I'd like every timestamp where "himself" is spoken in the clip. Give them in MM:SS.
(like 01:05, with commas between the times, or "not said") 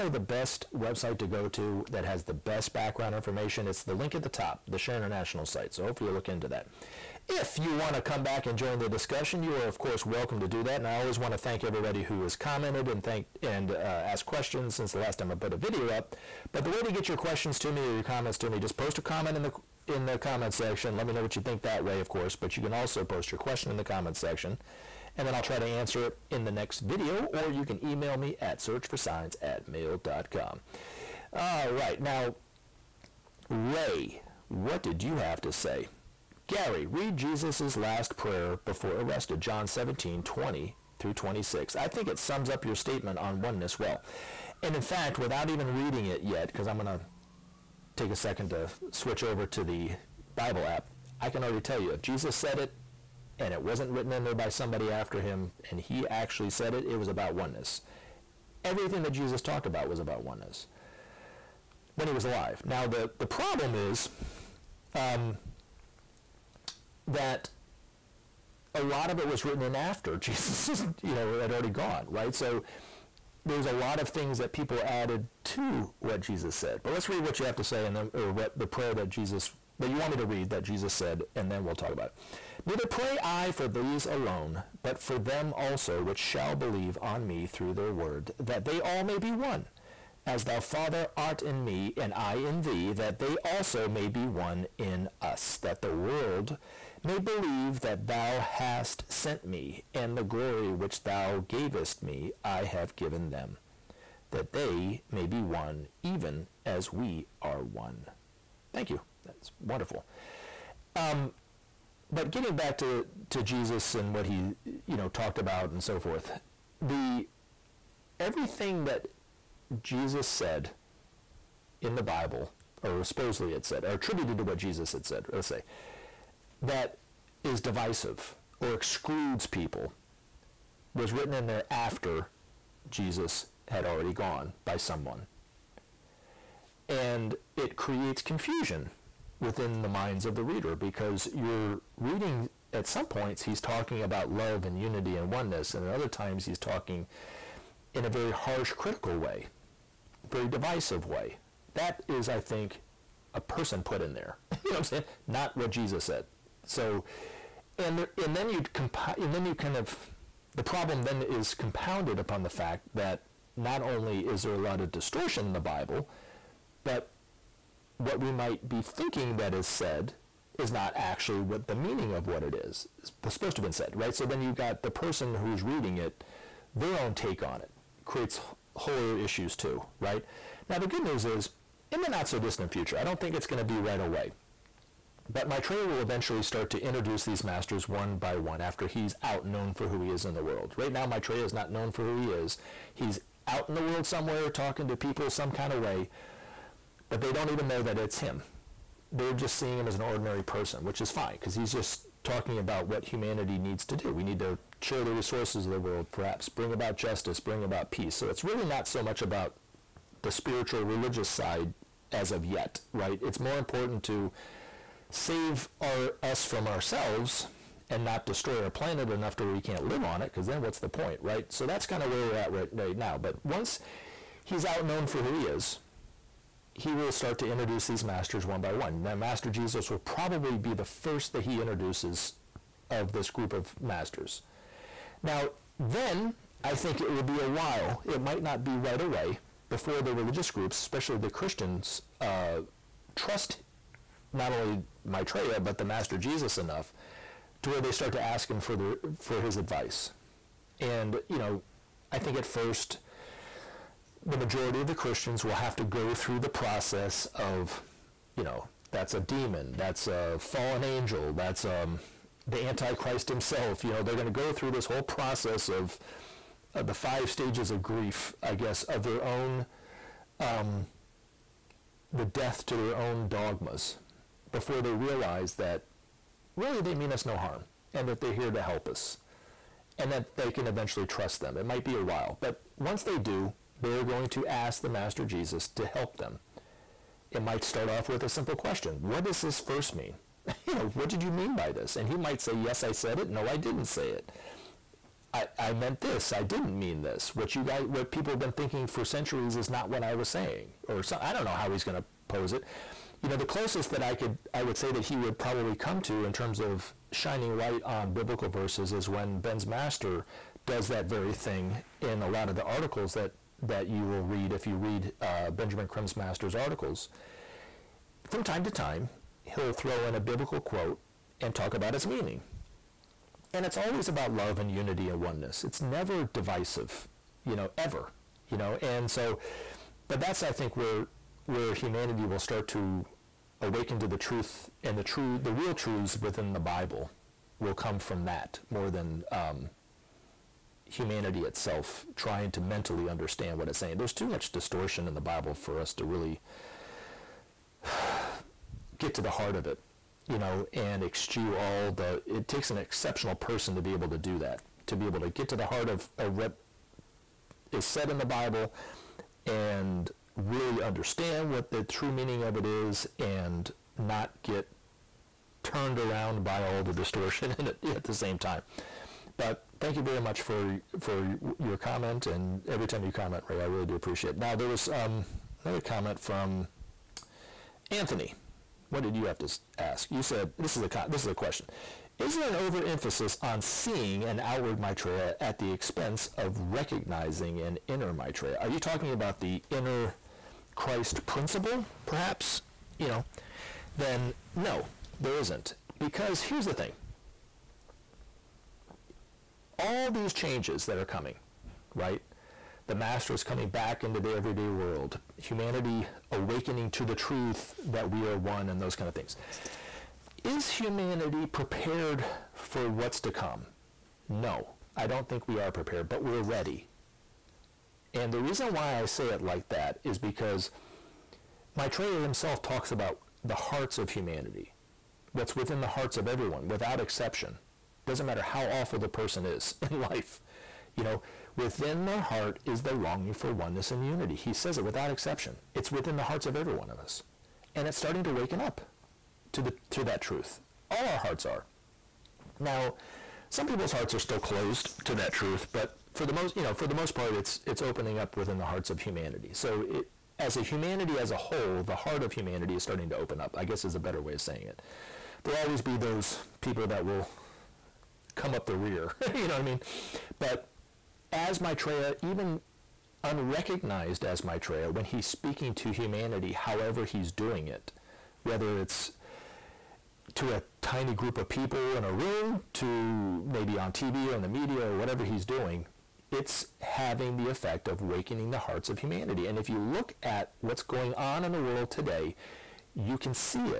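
04:23, 07:02.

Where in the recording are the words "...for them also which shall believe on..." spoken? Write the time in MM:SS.
01:25.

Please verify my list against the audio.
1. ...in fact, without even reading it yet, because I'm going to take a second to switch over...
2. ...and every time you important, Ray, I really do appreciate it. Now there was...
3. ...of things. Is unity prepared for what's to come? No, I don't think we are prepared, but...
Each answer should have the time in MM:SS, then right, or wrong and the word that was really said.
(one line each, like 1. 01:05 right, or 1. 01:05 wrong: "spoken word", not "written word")
1. 00:44 right
2. 06:12 wrong: "comment", not "important"
3. 06:49 wrong: "humanity", not "unity".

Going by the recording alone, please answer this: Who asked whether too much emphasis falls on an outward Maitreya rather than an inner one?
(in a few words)
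Anthony.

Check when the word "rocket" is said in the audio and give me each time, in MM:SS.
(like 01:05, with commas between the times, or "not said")
not said.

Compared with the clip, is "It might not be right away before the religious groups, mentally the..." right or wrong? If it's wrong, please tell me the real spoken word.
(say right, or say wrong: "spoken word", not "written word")
wrong: "especially", not "mentally".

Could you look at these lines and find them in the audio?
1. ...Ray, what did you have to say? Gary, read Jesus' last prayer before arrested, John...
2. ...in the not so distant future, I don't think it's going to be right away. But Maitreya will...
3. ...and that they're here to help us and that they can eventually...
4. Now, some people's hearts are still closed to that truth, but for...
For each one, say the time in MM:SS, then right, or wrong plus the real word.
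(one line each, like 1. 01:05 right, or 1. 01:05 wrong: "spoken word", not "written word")
1. 00:33 right
2. 03:01 right
3. 04:37 right
4. 07:22 right.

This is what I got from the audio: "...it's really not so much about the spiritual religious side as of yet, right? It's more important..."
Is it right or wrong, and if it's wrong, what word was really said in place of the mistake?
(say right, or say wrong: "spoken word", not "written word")
right.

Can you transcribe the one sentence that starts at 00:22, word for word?
But you can also post your question in the comment section, and then I'll try to answer it in the next video.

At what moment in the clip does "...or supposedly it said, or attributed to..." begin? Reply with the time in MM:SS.
02:02.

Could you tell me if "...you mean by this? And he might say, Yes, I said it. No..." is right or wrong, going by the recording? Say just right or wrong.
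right.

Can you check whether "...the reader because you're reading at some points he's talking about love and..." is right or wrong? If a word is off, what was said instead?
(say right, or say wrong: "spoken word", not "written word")
right.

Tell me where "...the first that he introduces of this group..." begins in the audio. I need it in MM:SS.
03:50.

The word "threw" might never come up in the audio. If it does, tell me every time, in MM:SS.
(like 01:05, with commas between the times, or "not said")
not said.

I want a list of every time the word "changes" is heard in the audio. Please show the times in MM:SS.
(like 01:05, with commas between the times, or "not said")
06:40.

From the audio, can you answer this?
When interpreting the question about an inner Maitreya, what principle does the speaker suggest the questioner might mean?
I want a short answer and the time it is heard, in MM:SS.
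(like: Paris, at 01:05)
inner Christ principle, at 06:29.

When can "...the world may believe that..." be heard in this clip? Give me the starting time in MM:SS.
01:35.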